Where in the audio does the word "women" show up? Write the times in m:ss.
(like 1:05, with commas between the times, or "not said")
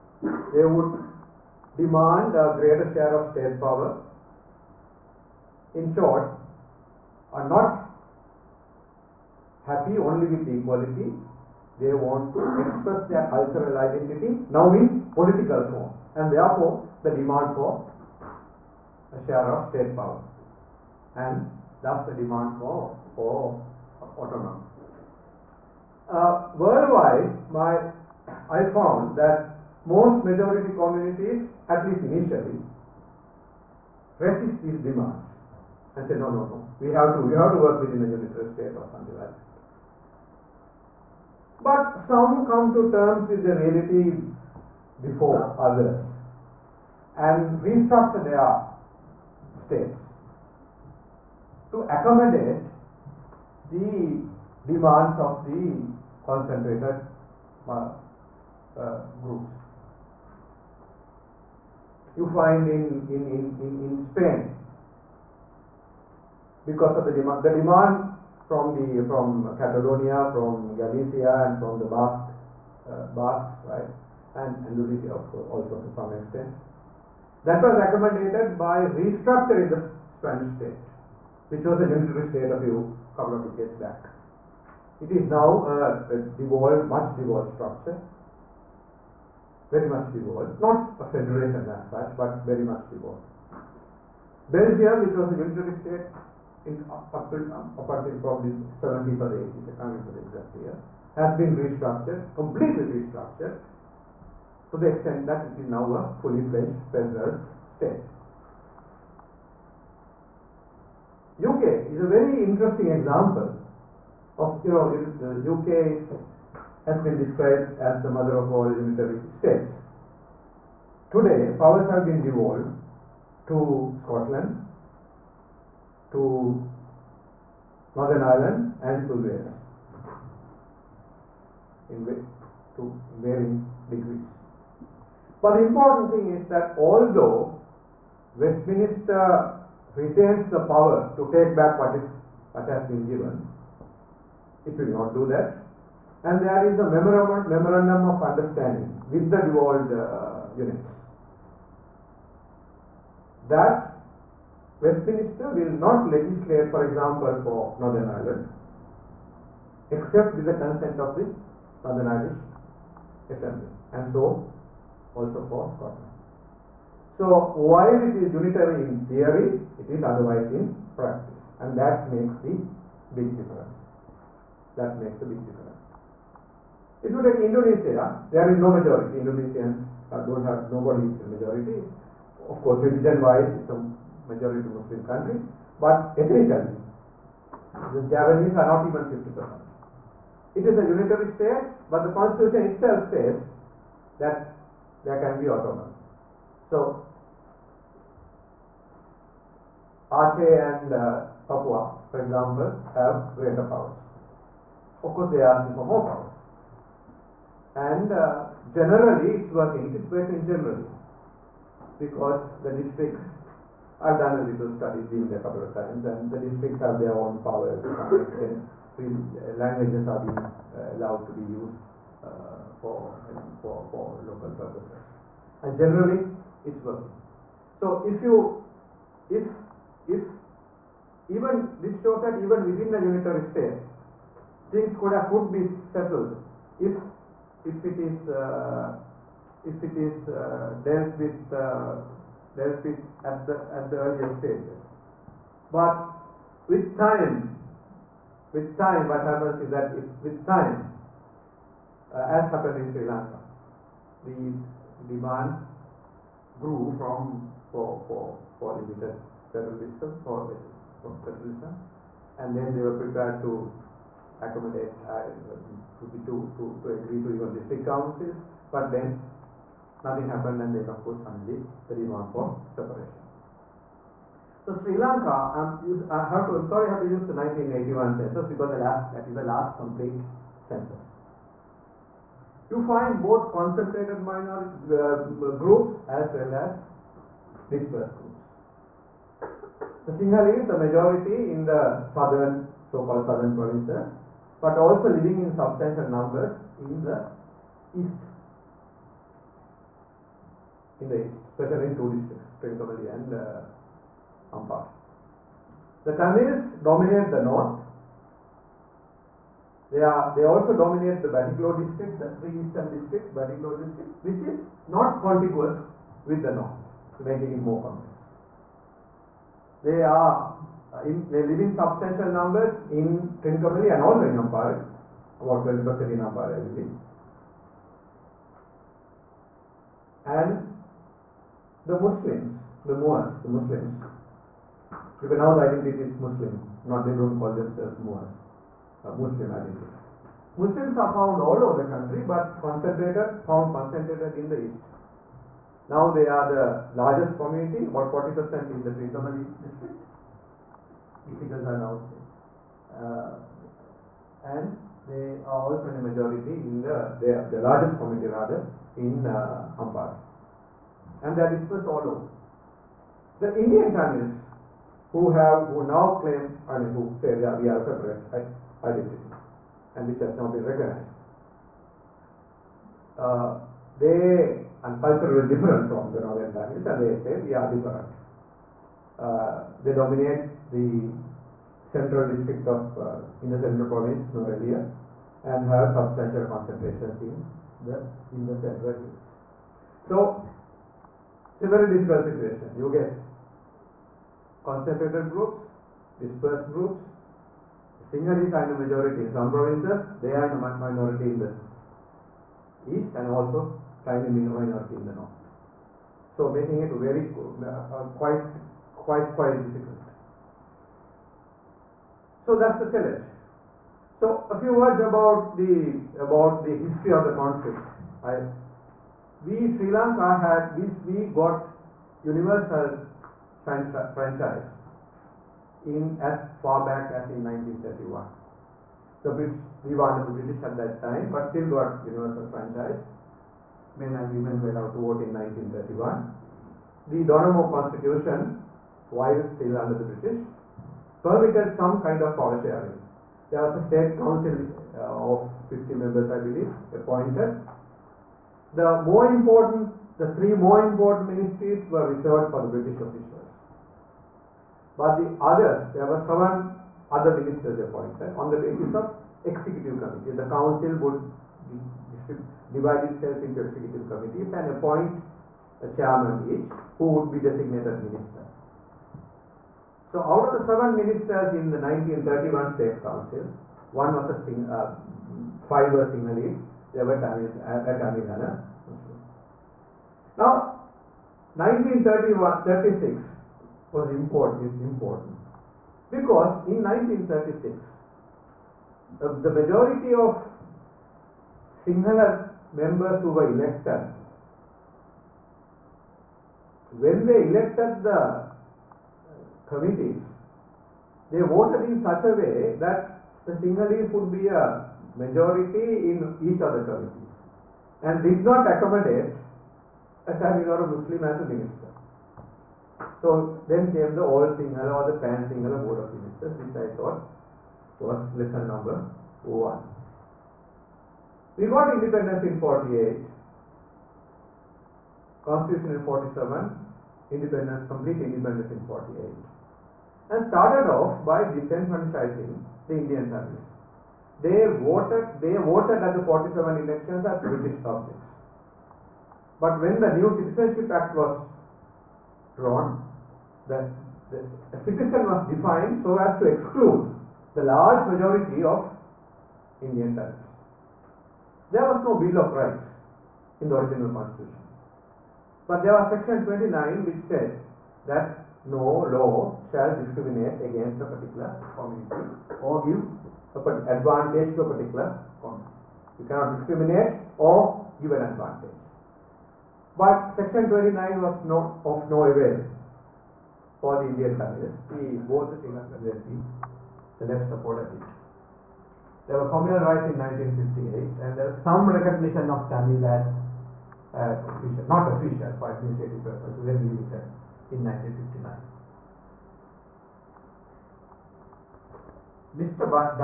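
7:14.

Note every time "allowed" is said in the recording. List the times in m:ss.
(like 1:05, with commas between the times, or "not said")
3:40, 7:14.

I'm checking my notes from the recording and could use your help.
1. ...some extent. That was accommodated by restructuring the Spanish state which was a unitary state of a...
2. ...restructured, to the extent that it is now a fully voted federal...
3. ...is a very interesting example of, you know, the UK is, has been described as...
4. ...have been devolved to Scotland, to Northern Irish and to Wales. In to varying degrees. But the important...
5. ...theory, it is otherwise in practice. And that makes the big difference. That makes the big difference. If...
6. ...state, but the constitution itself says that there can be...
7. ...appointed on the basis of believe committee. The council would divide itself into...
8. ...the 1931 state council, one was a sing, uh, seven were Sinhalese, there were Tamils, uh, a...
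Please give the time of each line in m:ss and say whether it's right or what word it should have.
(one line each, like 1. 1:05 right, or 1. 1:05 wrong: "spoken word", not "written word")
1. 1:15 right
2. 1:42 wrong: "fledged", not "voted"
3. 1:51 right
4. 2:01 wrong: "Ireland", not "Irish"
5. 2:49 right
6. 3:11 right
7. 7:37 wrong: "executive", not "believe"
8. 7:51 wrong: "five", not "seven".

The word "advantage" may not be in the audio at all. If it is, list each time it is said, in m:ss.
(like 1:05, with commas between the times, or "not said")
9:23, 9:28.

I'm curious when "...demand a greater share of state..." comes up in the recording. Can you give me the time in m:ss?
0:01.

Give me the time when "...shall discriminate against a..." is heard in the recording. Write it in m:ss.
9:19.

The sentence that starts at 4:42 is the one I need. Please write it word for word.
You find both concentrated minority uh, groups as well as dispersed groups.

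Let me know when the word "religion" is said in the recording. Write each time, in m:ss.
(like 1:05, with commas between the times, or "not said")
3:02.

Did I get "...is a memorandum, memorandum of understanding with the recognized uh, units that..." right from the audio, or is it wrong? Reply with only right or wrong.
wrong.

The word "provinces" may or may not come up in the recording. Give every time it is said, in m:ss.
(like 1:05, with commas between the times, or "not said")
4:53, 6:23, 6:39.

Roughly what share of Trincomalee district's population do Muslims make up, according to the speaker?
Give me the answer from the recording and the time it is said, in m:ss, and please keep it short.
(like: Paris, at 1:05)
40%, at 5:48.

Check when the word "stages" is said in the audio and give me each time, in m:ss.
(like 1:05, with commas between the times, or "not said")
4:04.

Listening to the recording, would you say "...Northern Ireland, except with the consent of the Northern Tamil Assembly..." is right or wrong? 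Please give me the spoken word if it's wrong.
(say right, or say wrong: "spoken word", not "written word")
wrong: "Irish", not "Tamil".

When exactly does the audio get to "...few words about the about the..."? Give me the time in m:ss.
6:54.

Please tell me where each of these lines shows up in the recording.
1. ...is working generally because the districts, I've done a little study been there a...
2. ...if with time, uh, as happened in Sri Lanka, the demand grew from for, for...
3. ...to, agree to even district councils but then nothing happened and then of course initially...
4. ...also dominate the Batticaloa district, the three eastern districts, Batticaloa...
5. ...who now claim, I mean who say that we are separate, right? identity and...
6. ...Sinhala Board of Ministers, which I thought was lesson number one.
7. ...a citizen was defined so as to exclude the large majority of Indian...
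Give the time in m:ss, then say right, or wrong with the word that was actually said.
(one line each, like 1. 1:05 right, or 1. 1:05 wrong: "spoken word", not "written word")
1. 3:29 right
2. 4:09 right
3. 4:26 wrong: "finally", not "initially"
4. 5:10 right
5. 6:05 right
6. 8:35 right
7. 9:04 right.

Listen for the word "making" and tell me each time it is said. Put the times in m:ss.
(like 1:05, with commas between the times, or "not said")
5:17, 6:46.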